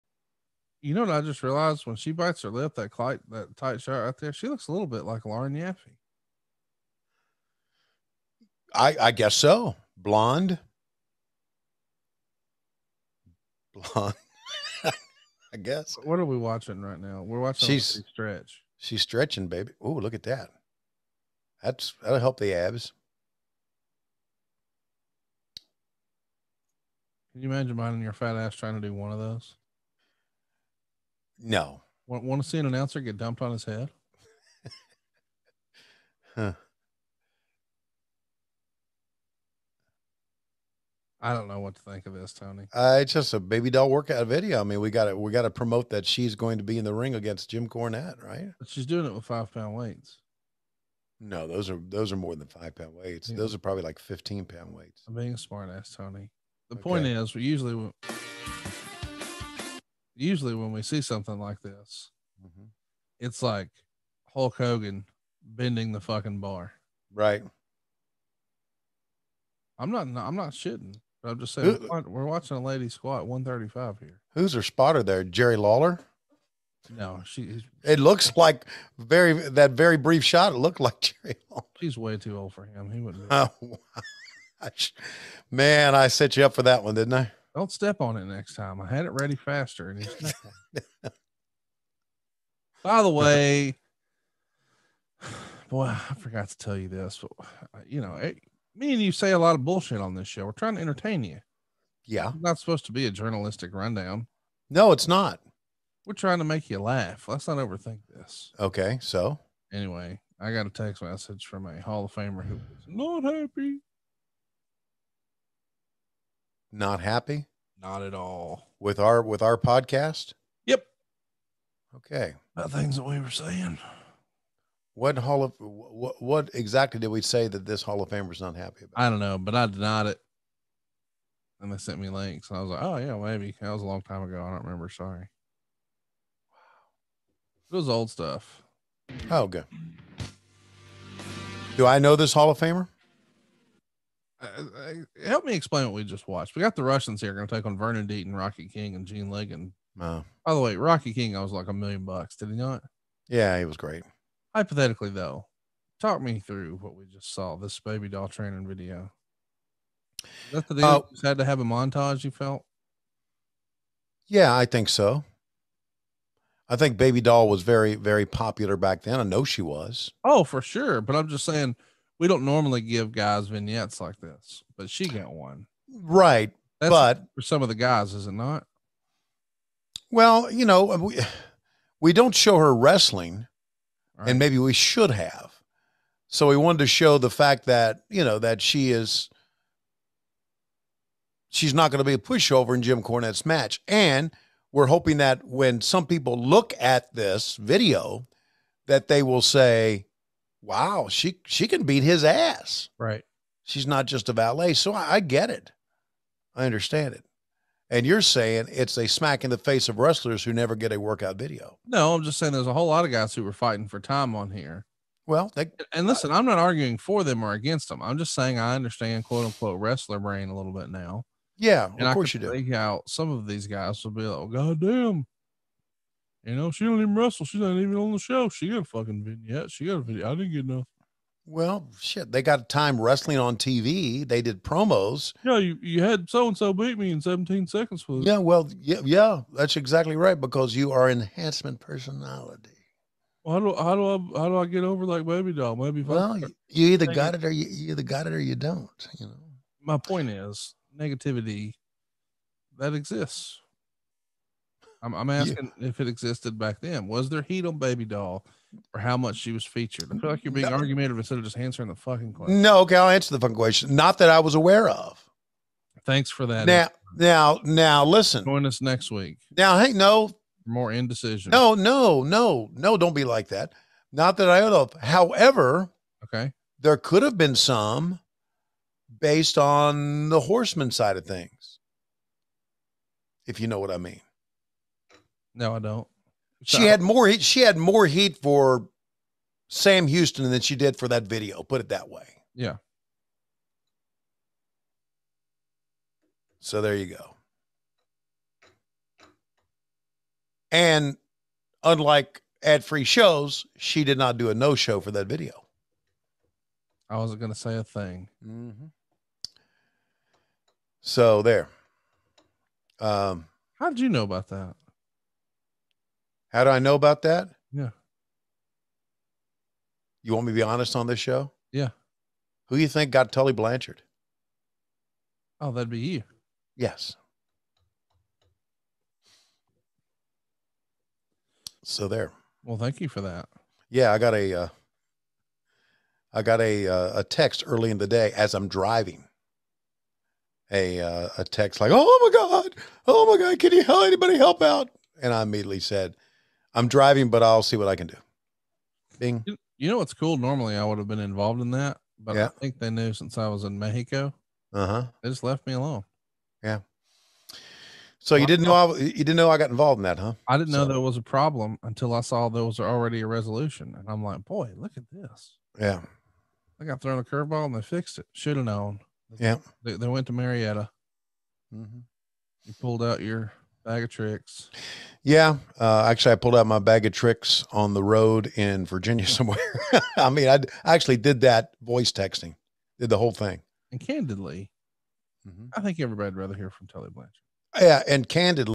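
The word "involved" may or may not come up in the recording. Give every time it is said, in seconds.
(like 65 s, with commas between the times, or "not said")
351 s, 359 s.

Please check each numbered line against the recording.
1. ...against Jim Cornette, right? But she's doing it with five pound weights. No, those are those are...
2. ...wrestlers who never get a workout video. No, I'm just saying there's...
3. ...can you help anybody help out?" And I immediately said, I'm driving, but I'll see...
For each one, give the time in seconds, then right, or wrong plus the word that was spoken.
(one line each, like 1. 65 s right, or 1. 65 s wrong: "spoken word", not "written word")
1. 47 s right
2. 209 s right
3. 343 s right.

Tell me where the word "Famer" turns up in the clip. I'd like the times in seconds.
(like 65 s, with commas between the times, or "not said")
112 s, 128 s, 142 s.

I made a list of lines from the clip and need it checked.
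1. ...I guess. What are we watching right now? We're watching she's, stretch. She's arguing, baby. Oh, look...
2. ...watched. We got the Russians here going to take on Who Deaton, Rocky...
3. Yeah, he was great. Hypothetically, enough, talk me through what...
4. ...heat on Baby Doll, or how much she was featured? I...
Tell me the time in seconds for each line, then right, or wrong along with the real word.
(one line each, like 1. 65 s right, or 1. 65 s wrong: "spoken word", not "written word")
1. 15 s wrong: "stretching", not "arguing"
2. 146 s wrong: "Vernon", not "Who"
3. 153 s wrong: "though", not "enough"
4. 257 s right.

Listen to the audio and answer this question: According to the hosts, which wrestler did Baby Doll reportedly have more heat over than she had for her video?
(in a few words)
Sam Houston.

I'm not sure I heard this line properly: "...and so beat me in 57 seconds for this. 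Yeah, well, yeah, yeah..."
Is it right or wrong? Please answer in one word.
wrong.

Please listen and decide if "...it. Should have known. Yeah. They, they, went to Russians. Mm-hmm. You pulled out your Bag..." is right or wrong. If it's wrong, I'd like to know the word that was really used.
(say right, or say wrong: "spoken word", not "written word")
wrong: "Marietta", not "Russians".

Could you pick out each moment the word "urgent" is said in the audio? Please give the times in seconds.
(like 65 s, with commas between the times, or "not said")
not said.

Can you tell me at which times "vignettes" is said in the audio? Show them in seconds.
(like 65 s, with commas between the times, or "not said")
173 s, 229 s.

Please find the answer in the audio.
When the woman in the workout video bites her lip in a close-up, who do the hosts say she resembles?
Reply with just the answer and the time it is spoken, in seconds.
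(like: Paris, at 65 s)
Lauren Yaffe, at 5 s.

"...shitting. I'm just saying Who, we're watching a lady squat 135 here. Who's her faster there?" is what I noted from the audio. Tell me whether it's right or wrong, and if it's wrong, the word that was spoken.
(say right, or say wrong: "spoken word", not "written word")
wrong: "spotter", not "faster".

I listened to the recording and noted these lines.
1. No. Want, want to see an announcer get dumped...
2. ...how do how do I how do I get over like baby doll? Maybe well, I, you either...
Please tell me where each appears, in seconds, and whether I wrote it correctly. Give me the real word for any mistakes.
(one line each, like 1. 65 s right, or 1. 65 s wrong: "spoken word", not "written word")
1. 31 s right
2. 243 s right.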